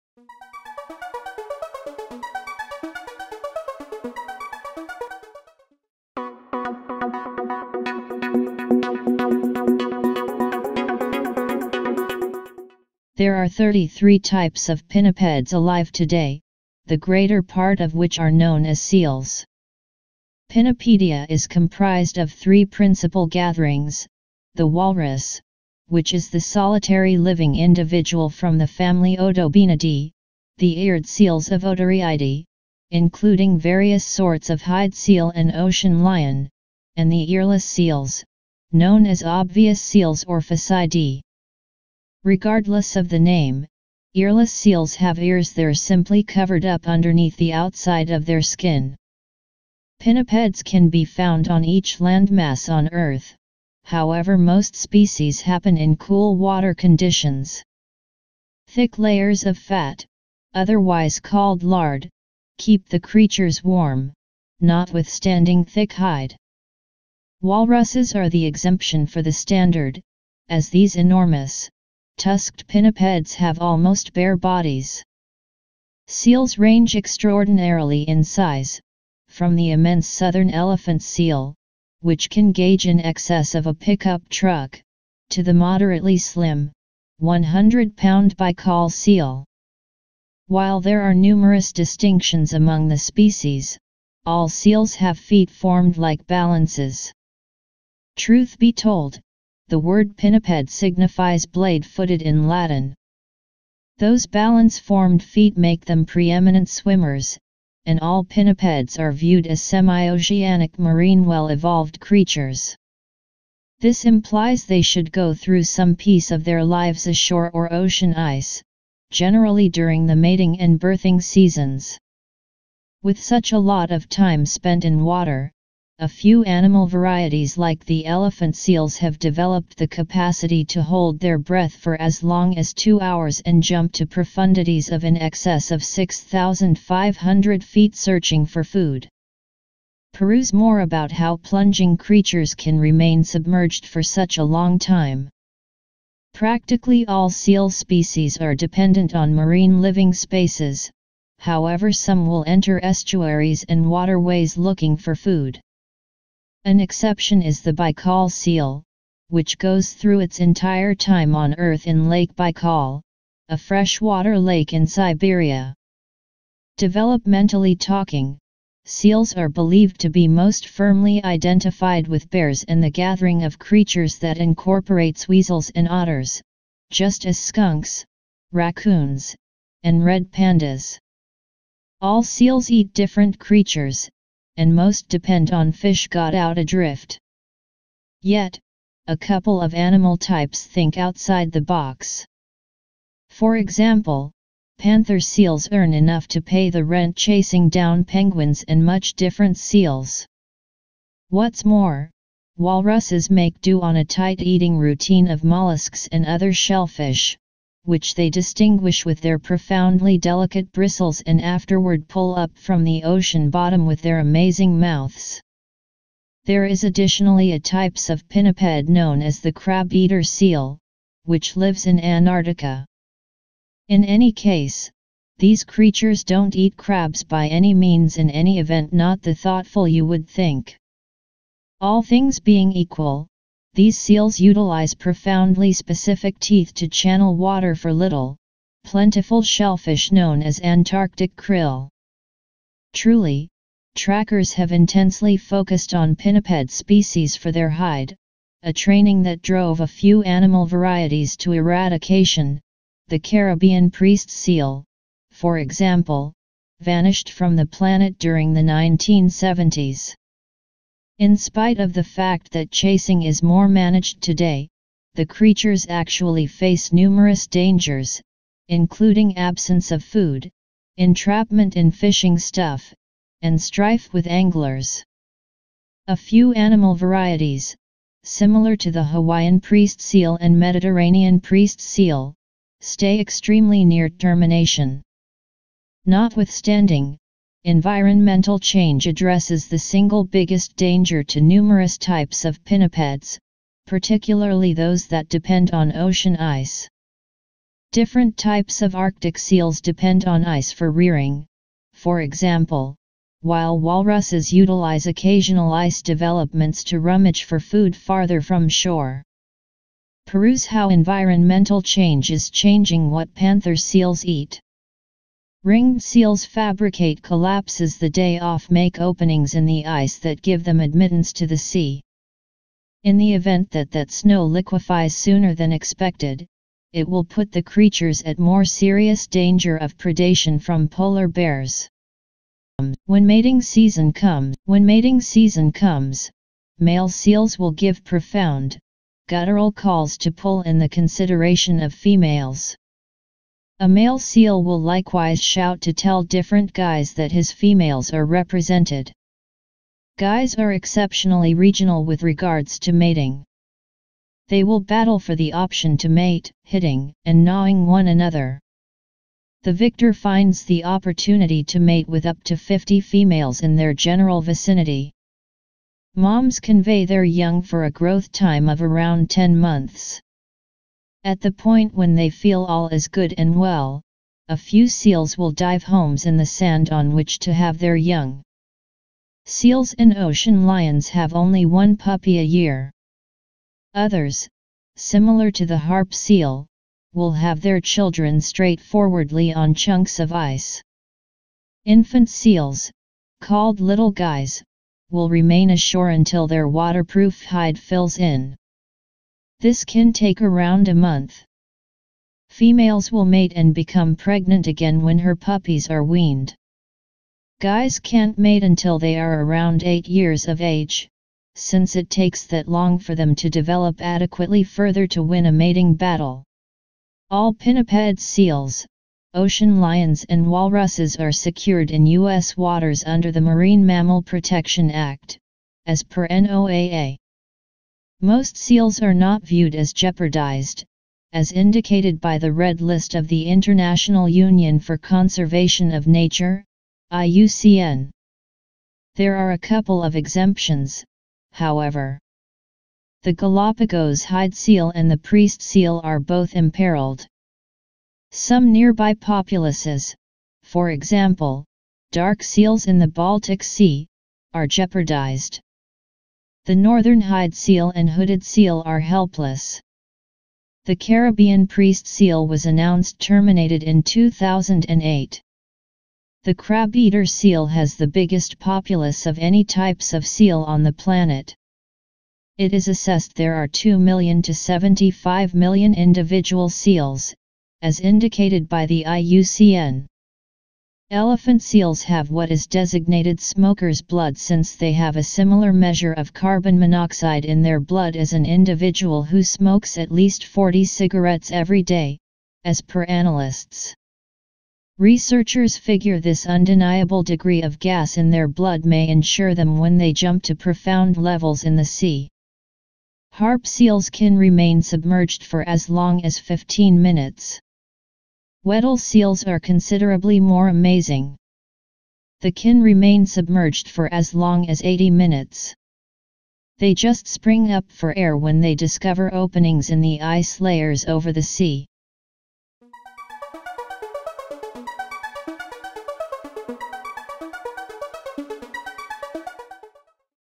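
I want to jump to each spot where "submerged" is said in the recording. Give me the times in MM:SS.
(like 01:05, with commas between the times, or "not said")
02:23, 08:24, 08:33.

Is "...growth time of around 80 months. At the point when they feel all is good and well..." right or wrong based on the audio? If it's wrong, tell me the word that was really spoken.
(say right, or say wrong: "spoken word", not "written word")
wrong: "10", not "80".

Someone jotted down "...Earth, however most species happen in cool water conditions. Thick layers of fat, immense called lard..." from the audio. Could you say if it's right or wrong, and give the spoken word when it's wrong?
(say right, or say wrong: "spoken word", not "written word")
wrong: "otherwise", not "immense".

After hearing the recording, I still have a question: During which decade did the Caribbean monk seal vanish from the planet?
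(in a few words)
1970s.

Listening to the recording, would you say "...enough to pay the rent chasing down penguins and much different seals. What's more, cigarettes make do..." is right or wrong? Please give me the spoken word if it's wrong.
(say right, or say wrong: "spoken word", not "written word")
wrong: "walruses", not "cigarettes".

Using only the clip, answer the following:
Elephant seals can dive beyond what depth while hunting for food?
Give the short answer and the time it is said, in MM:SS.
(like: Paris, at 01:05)
6,500 feet, at 02:15.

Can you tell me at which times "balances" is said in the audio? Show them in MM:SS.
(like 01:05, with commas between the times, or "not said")
01:36, 01:44.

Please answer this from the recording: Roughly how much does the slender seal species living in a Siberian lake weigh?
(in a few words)
100 pounds.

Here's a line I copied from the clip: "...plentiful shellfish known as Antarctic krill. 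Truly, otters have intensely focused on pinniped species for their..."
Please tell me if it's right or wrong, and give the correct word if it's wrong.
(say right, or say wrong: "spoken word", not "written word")
wrong: "trackers", not "otters".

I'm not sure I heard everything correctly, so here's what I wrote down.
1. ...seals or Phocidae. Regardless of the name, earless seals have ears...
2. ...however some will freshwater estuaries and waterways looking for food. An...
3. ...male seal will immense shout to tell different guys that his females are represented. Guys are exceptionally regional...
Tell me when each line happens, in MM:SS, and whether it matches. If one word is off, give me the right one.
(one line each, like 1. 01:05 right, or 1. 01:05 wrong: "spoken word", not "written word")
1. 00:39 right
2. 02:31 wrong: "enter", not "freshwater"
3. 05:43 wrong: "likewise", not "immense".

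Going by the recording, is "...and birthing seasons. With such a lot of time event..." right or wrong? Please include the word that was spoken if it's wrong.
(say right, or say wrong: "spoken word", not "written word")
wrong: "spent", not "event".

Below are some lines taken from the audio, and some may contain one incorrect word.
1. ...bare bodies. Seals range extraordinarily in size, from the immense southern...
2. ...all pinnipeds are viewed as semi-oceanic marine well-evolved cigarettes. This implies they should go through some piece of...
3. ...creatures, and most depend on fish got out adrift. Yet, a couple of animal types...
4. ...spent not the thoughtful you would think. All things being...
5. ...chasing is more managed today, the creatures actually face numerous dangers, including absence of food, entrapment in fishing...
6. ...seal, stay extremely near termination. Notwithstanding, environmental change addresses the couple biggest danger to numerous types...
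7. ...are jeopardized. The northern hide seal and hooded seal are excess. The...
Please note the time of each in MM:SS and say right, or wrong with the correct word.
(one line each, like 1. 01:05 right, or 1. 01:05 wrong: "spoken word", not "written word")
1. 01:14 right
2. 01:48 wrong: "creatures", not "cigarettes"
3. 03:03 right
4. 03:48 wrong: "event", not "spent"
5. 04:22 right
6. 04:41 wrong: "single", not "couple"
7. 07:34 wrong: "helpless", not "excess".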